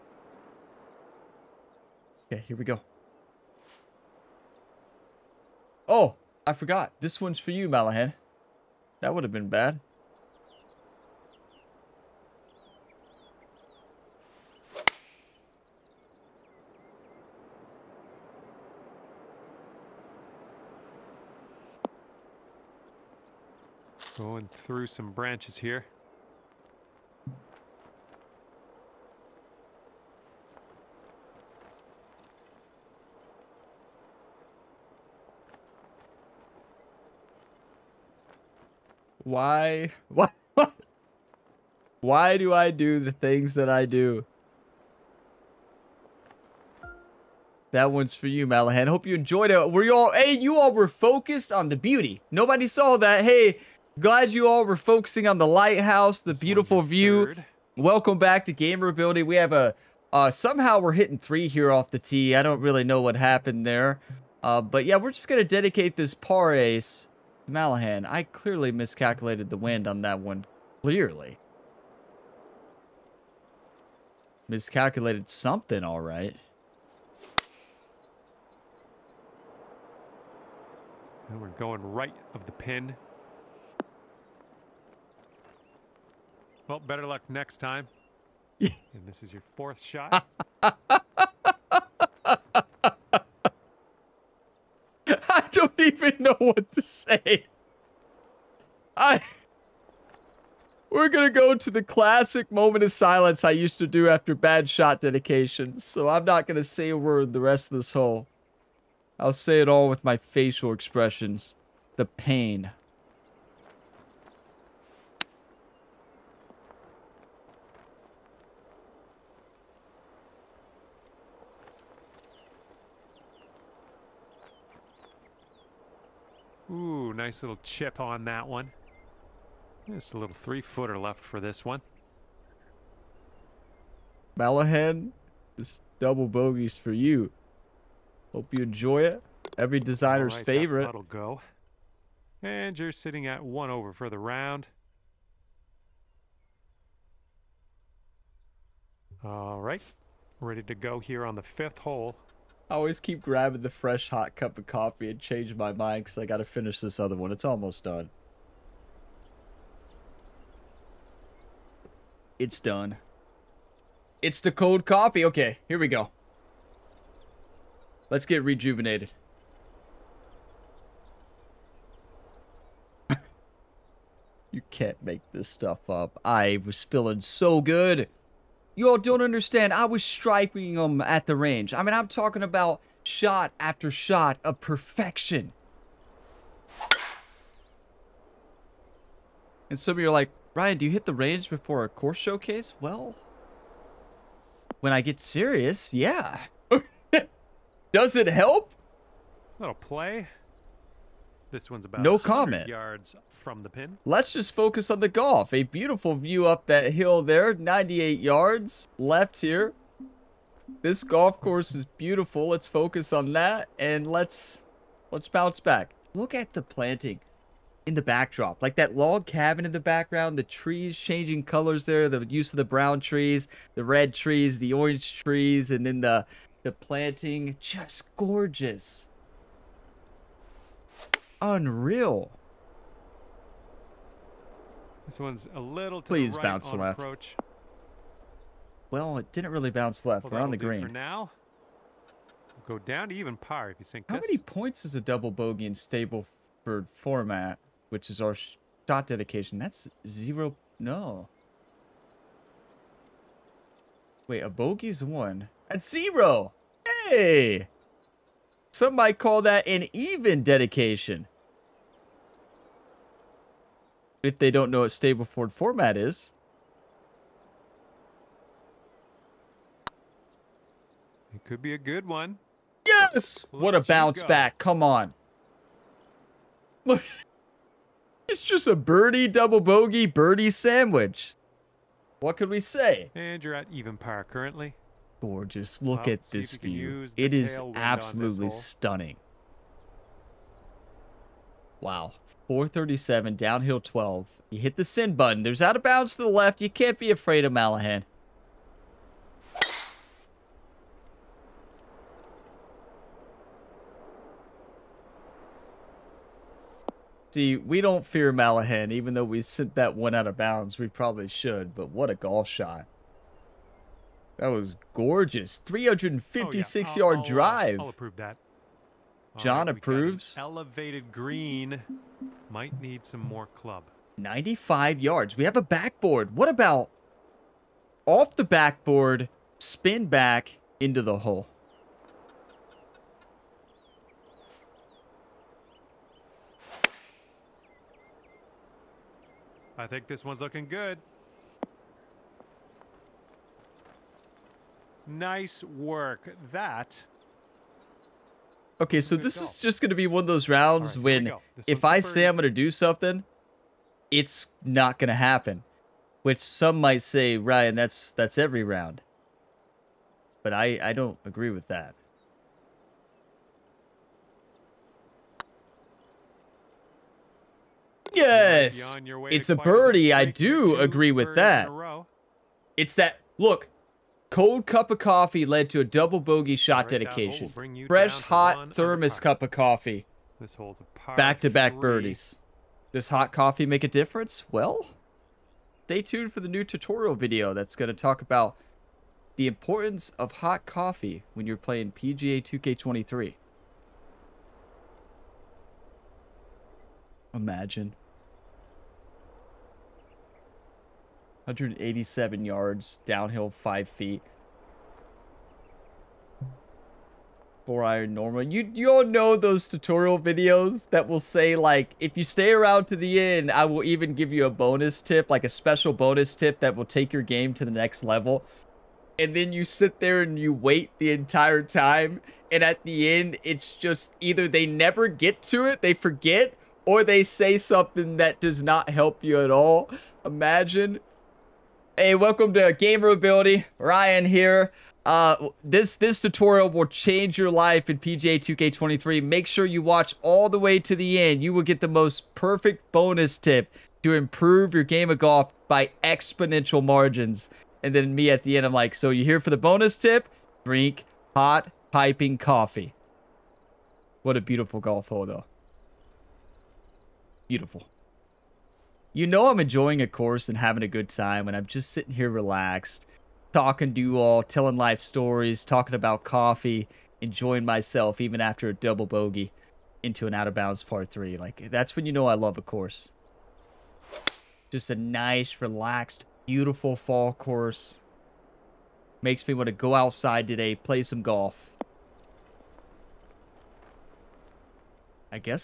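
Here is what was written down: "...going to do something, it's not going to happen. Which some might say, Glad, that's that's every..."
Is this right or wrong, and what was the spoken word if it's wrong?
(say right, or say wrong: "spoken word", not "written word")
wrong: "Ryan", not "Glad".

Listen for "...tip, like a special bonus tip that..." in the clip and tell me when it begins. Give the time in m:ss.
6:55.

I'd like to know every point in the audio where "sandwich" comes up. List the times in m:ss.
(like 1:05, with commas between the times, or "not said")
4:40.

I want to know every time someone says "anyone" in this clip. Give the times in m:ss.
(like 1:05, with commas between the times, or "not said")
not said.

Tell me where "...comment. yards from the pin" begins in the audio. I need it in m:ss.
3:22.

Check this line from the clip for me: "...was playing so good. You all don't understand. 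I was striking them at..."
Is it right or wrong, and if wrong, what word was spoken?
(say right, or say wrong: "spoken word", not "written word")
wrong: "feeling", not "playing".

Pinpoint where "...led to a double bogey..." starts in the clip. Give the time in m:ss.
6:15.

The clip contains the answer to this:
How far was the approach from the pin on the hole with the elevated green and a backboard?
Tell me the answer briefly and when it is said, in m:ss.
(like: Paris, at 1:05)
95 yards, at 5:24.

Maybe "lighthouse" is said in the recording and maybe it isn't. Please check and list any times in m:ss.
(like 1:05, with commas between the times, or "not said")
0:55.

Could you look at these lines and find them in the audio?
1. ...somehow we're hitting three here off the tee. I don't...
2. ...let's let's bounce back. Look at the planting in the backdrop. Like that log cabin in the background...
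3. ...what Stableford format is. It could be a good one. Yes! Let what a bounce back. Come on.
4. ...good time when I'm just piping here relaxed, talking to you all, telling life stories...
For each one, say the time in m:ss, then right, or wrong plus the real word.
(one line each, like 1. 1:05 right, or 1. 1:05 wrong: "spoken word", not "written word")
1. 1:00 right
2. 3:34 right
3. 4:24 right
4. 7:40 wrong: "sitting", not "piping".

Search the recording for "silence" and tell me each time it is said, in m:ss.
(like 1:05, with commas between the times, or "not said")
1:42.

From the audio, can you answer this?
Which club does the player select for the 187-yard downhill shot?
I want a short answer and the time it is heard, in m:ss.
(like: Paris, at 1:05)
4 iron, at 6:47.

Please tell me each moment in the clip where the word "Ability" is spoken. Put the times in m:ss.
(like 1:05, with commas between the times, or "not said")
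0:58, 7:13.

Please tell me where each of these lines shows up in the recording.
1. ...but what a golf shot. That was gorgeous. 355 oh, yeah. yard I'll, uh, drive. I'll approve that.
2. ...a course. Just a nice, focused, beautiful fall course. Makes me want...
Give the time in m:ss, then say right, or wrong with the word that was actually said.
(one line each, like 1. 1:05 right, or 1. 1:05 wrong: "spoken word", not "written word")
1. 5:11 wrong: "356", not "355"
2. 7:52 wrong: "relaxed", not "focused".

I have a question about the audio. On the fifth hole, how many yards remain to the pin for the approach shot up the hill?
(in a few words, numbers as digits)
98.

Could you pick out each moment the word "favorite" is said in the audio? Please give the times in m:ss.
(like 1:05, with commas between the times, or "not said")
2:20.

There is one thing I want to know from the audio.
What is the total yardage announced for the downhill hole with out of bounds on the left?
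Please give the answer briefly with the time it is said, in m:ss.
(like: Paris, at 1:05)
437, at 4:52.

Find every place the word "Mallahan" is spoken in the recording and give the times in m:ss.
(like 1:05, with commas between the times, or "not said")
0:07, 0:48, 1:07, 2:14, 4:57, 5:08.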